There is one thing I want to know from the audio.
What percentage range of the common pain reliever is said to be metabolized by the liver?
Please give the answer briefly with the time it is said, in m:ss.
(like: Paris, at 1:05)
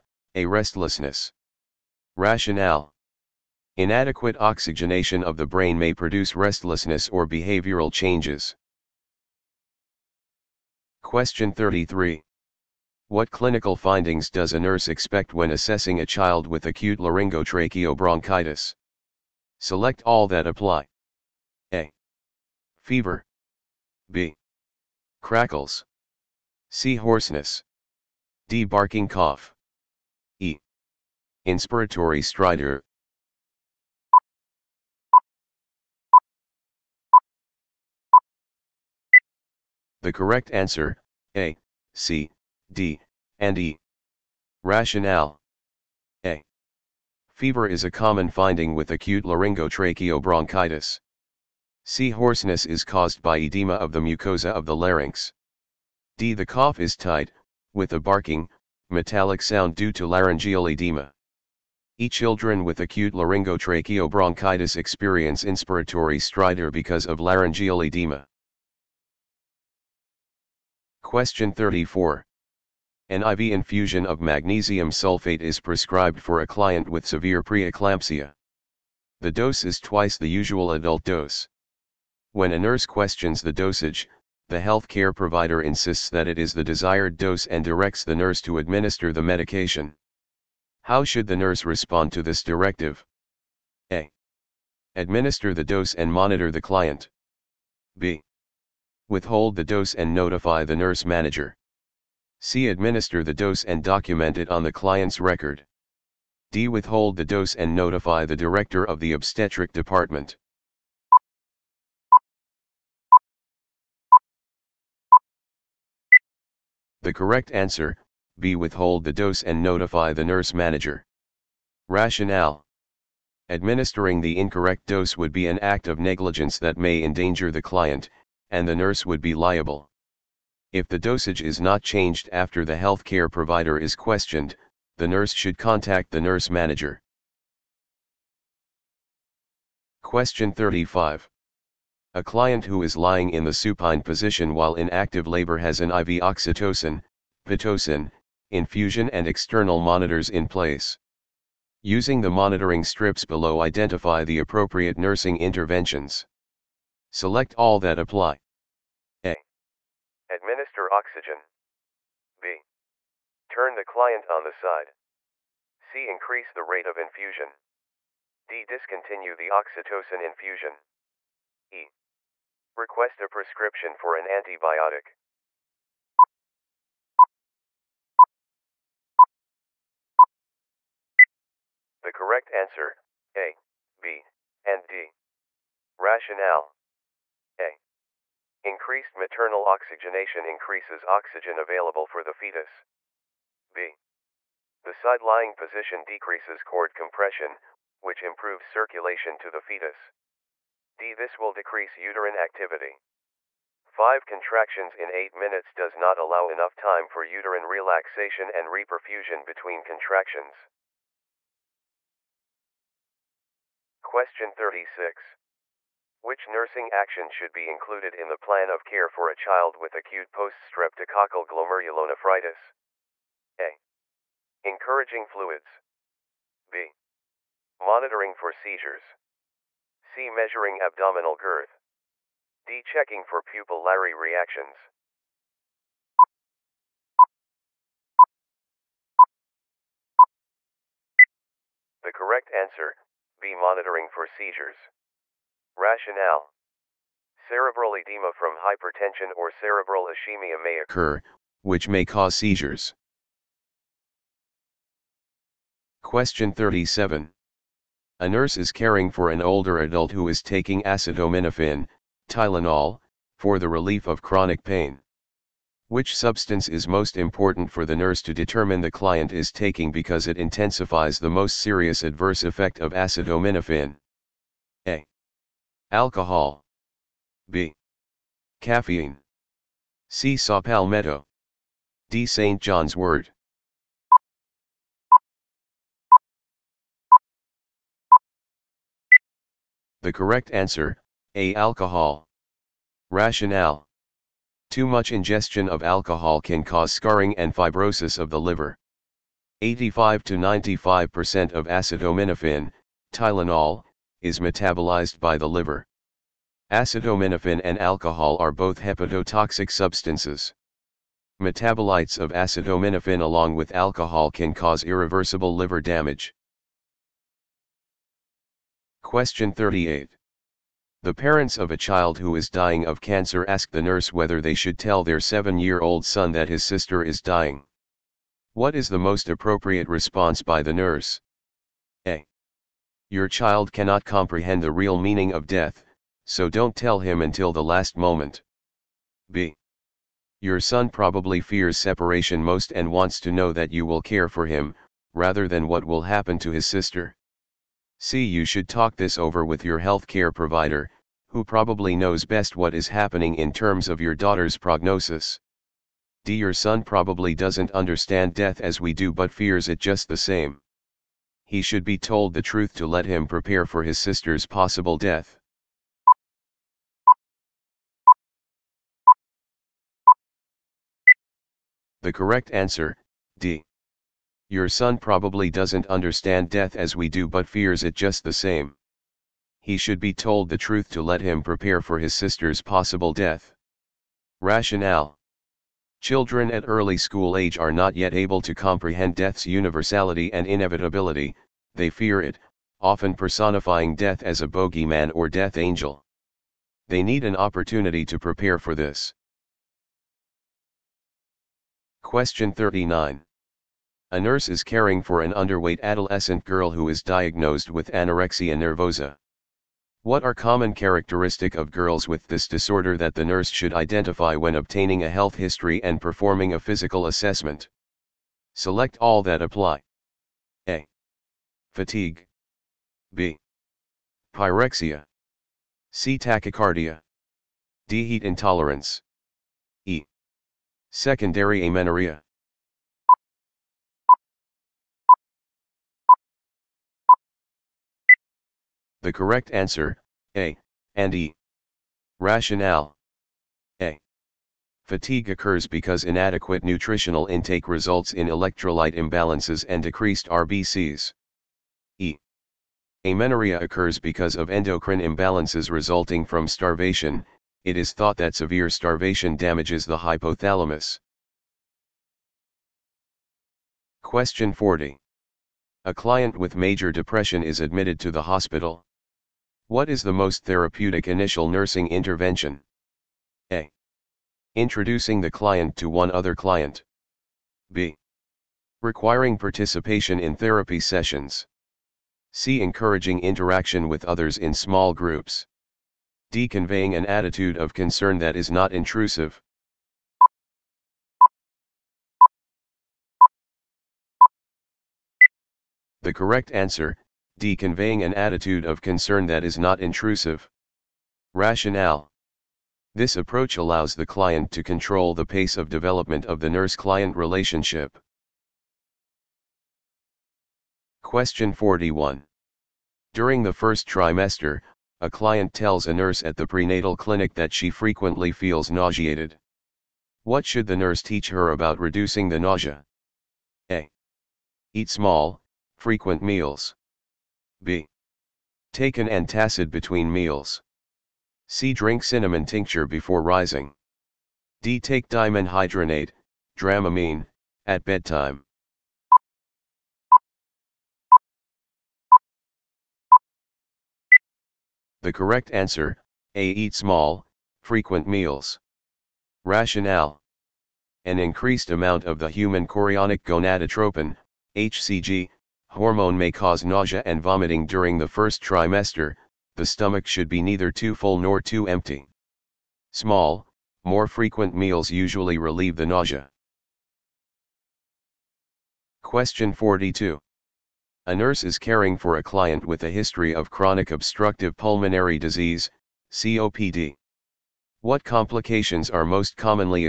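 85 to 95%, at 4:59.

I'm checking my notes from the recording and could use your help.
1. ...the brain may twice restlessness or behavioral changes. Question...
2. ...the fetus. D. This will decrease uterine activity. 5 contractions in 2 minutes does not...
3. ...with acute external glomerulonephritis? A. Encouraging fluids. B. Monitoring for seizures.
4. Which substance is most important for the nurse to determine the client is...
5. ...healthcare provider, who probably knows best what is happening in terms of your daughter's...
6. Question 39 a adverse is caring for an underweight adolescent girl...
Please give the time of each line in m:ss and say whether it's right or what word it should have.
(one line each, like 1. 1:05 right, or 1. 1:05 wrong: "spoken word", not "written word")
1. 0:05 wrong: "produce", not "twice"
2. 3:19 wrong: "8", not "2"
3. 3:39 wrong: "poststreptococcal", not "external"
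4. 4:25 right
5. 5:49 right
6. 6:42 wrong: "nurse", not "adverse".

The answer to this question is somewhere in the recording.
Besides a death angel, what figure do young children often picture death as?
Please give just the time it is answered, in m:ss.
6:34.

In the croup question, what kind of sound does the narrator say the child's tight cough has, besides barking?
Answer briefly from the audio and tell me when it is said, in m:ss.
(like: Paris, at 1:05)
metallic, at 0:58.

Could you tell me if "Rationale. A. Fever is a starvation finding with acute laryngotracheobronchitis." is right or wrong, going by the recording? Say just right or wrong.
wrong.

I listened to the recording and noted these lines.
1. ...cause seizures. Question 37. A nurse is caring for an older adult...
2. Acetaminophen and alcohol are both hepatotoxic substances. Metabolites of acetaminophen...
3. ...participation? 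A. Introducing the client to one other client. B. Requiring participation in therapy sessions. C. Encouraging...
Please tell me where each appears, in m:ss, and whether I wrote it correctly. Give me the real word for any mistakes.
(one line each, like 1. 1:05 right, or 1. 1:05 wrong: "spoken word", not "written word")
1. 4:12 right
2. 5:06 right
3. 7:51 wrong: "intervention", not "participation".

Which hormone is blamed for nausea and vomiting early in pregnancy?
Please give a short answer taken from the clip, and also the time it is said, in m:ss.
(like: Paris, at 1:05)
human chorionic gonadotropin, at 9:12.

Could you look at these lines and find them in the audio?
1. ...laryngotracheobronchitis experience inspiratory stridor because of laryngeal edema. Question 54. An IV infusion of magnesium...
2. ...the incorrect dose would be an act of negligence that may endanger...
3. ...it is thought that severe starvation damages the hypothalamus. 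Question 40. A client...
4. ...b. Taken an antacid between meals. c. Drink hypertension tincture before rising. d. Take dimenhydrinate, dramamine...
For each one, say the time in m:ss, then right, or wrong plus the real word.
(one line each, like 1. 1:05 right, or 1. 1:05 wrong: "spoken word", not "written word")
1. 1:03 wrong: "34", not "54"
2. 2:04 right
3. 7:37 right
4. 8:47 wrong: "cinnamon", not "hypertension".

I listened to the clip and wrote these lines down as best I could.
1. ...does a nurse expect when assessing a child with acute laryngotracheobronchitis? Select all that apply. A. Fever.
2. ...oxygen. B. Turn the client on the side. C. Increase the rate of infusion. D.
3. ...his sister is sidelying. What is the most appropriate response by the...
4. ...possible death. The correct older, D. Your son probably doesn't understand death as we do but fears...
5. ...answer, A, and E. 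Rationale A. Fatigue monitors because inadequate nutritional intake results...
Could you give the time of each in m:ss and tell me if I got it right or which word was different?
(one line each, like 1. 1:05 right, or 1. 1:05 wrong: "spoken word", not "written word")
1. 0:14 right
2. 2:40 right
3. 5:26 wrong: "dying", not "sidelying"
4. 6:04 wrong: "answer", not "older"
5. 7:19 wrong: "occurs", not "monitors".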